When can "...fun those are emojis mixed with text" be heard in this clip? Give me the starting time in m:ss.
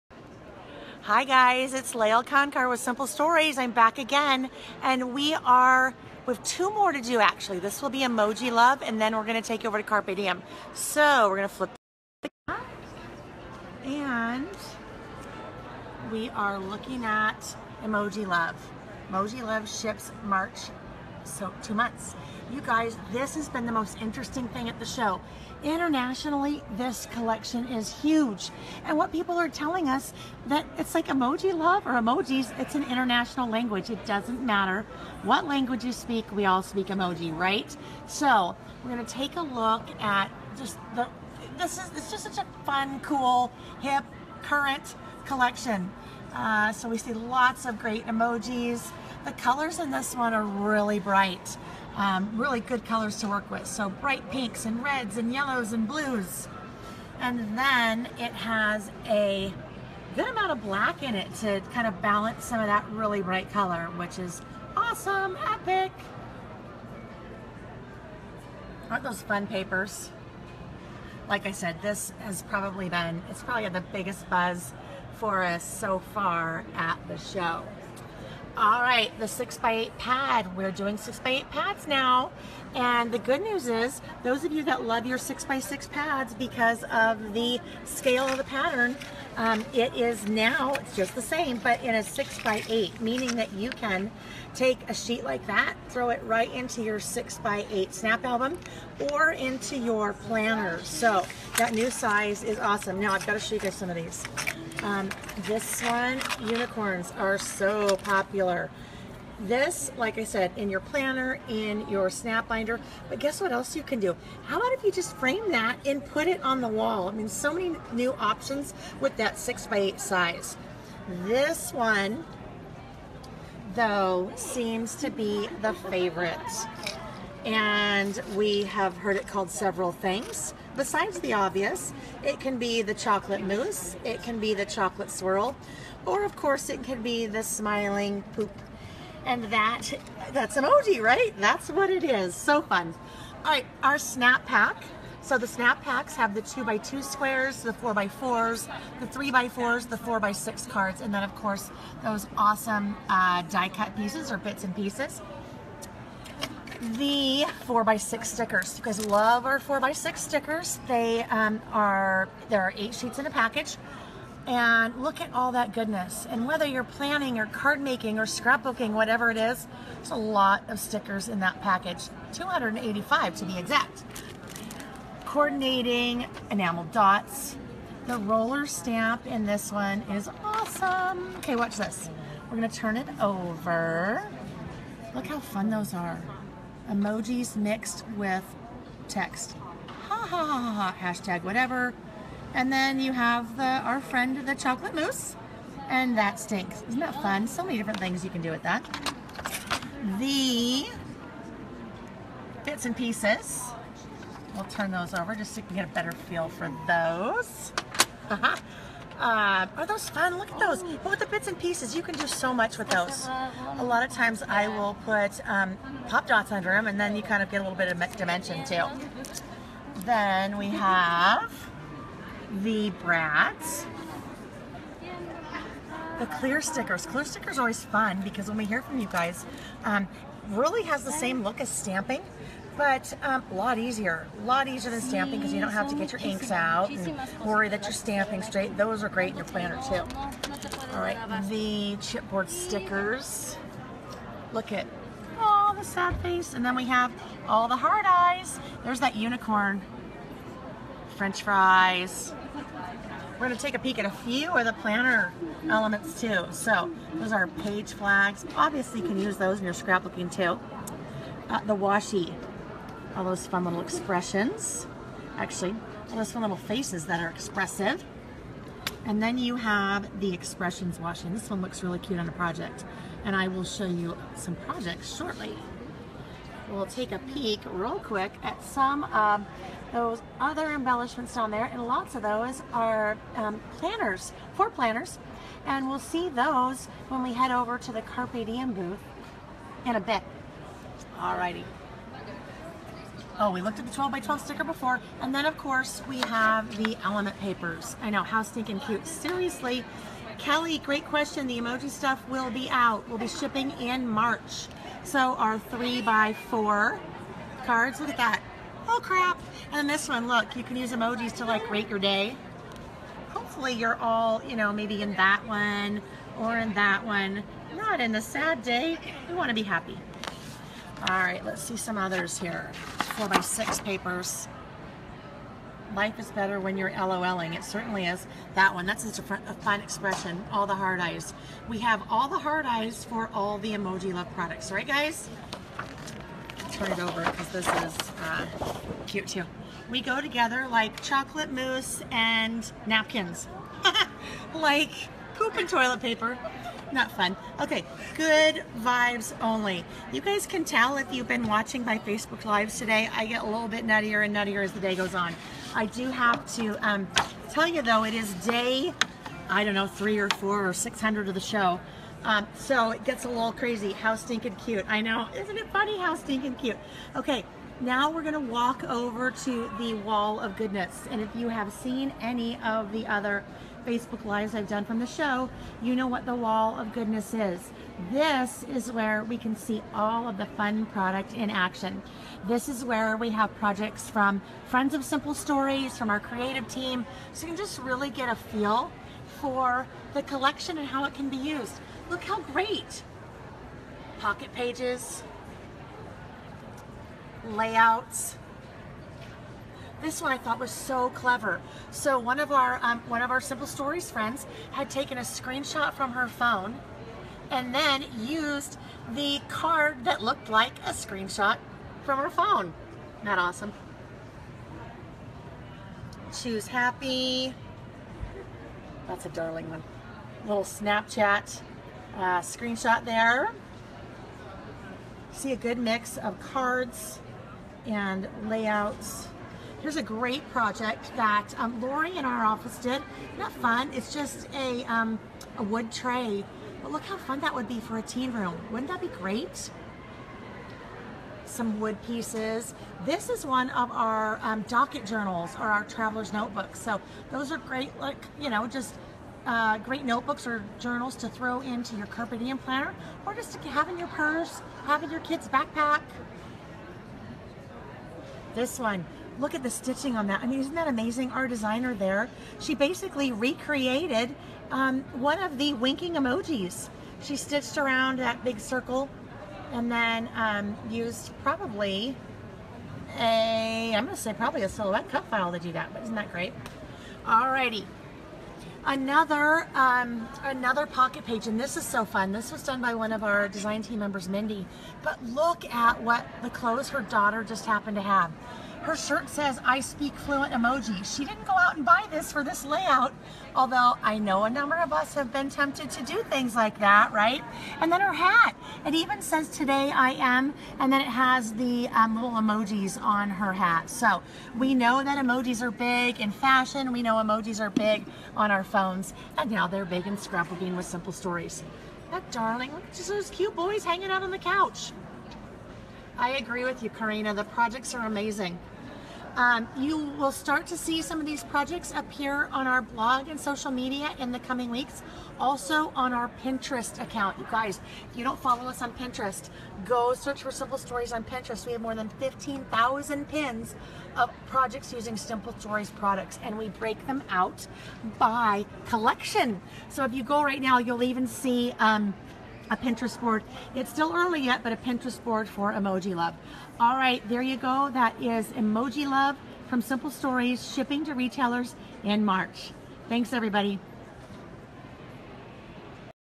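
3:05.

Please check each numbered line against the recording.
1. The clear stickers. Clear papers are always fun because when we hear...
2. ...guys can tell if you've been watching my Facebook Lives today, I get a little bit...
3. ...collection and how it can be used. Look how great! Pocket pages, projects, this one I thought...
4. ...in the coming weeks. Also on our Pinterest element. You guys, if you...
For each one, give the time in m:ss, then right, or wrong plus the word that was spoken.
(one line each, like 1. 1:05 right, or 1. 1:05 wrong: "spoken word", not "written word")
1. 3:46 wrong: "stickers", not "papers"
2. 5:50 right
3. 6:30 wrong: "layouts", not "projects"
4. 8:44 wrong: "account", not "element".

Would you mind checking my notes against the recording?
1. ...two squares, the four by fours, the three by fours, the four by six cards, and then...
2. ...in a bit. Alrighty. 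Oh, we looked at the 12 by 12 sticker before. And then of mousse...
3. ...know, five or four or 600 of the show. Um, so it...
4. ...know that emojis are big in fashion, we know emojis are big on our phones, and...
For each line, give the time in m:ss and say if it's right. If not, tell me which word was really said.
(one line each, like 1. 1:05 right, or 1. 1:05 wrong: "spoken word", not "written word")
1. 2:26 right
2. 4:49 wrong: "course", not "mousse"
3. 5:59 wrong: "three", not "five"
4. 8:24 right.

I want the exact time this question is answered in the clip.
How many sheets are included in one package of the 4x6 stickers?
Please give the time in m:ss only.
2:42.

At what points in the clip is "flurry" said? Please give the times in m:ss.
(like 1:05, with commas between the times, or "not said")
not said.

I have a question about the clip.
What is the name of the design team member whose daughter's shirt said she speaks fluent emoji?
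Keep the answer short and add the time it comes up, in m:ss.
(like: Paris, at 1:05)
Mindy, at 8:04.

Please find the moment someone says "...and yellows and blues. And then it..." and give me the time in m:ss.
0:55.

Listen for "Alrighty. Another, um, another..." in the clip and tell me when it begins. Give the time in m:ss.
7:57.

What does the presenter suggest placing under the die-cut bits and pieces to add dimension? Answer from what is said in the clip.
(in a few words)
pop dots.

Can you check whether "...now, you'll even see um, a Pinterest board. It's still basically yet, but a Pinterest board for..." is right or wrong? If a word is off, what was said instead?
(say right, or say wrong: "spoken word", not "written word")
wrong: "early", not "basically".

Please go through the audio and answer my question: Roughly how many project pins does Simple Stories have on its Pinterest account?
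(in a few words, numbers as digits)
15,000.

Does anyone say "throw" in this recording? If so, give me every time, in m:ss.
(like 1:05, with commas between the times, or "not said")
1:35, 7:31.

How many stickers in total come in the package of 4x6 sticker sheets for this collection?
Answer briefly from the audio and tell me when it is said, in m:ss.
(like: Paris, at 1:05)
285, at 2:52.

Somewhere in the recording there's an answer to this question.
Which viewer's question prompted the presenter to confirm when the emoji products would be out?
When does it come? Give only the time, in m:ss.
5:00.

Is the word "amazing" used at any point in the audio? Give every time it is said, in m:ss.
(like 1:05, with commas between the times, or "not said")
7:40, 8:38.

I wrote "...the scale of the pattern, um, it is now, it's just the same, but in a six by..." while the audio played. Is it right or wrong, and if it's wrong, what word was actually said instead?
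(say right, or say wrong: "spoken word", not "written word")
right.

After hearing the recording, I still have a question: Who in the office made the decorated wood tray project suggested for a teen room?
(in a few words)
Lori.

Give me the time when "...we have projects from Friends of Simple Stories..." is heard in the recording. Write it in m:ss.
6:23.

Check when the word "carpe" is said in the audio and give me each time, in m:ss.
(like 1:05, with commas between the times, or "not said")
0:09, 4:48, 7:32.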